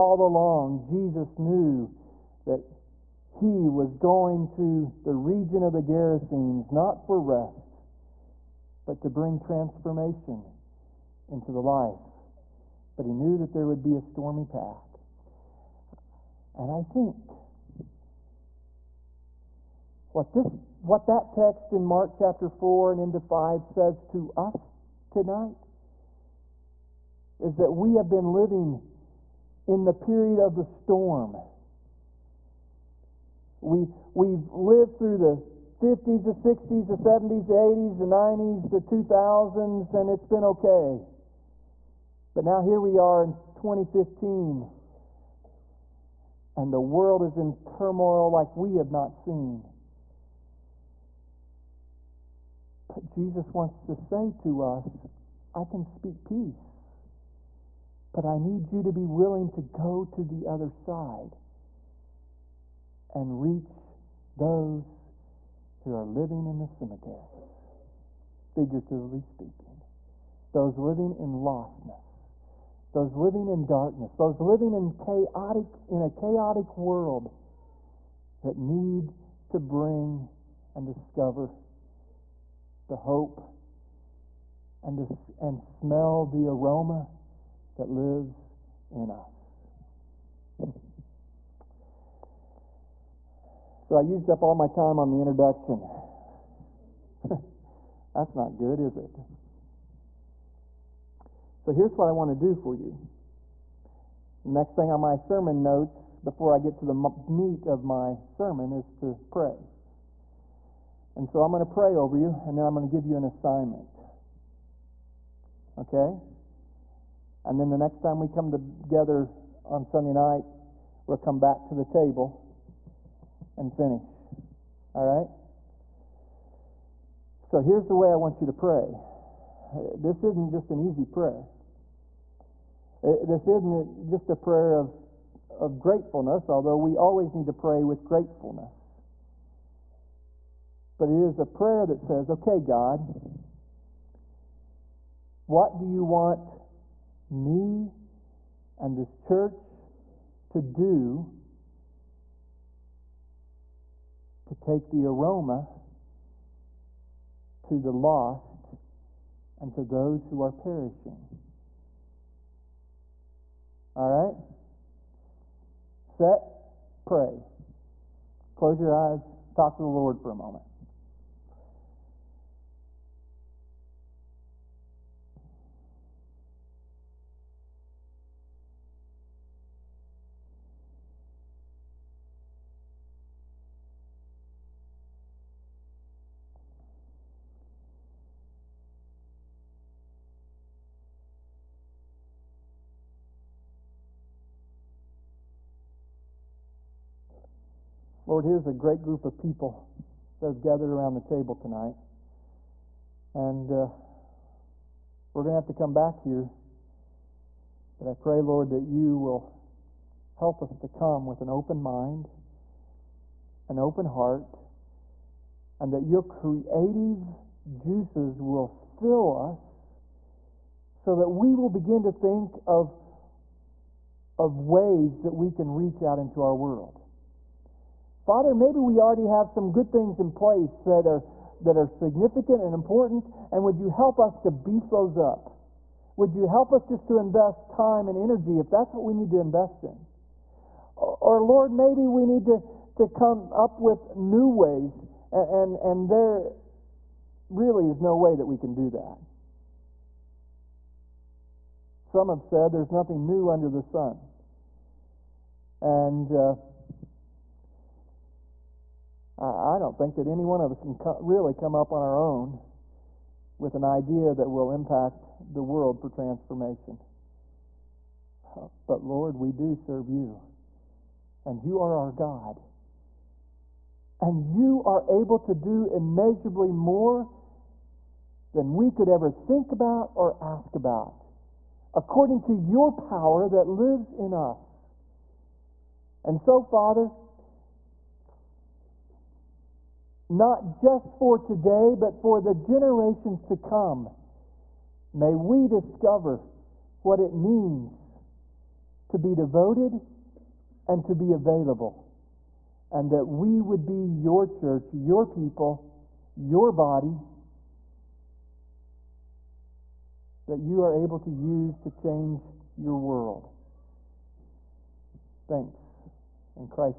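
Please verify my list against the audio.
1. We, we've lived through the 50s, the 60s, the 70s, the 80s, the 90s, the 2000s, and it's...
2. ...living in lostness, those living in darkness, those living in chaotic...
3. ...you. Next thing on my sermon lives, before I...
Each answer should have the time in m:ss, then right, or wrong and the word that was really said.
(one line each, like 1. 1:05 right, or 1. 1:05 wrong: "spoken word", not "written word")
1. 0:33 right
2. 1:10 right
3. 1:42 wrong: "notes", not "lives".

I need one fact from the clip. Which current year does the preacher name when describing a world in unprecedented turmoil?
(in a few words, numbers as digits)
2015.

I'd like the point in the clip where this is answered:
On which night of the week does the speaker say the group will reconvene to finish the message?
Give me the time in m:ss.
1:59.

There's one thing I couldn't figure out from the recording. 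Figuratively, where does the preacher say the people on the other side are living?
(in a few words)
cemeteries.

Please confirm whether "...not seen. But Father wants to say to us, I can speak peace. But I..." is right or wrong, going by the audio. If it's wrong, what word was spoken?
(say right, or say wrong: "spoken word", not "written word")
wrong: "Jesus", not "Father".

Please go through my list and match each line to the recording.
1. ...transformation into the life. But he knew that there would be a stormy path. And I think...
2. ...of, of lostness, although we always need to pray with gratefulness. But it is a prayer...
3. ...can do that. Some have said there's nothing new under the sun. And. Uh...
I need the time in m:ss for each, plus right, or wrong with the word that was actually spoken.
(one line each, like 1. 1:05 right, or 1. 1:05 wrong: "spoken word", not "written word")
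1. 0:09 right
2. 2:14 wrong: "gratefulness", not "lostness"
3. 4:08 right.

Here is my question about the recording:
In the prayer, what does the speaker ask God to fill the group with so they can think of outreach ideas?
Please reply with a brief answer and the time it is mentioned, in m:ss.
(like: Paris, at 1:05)
creative juices, at 3:36.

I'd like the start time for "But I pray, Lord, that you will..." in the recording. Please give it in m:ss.
3:27.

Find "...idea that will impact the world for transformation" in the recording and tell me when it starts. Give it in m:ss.
4:23.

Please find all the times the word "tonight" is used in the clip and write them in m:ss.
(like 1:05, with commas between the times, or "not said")
0:25, 3:21.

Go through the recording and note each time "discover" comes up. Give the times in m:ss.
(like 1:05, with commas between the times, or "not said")
1:20, 4:55.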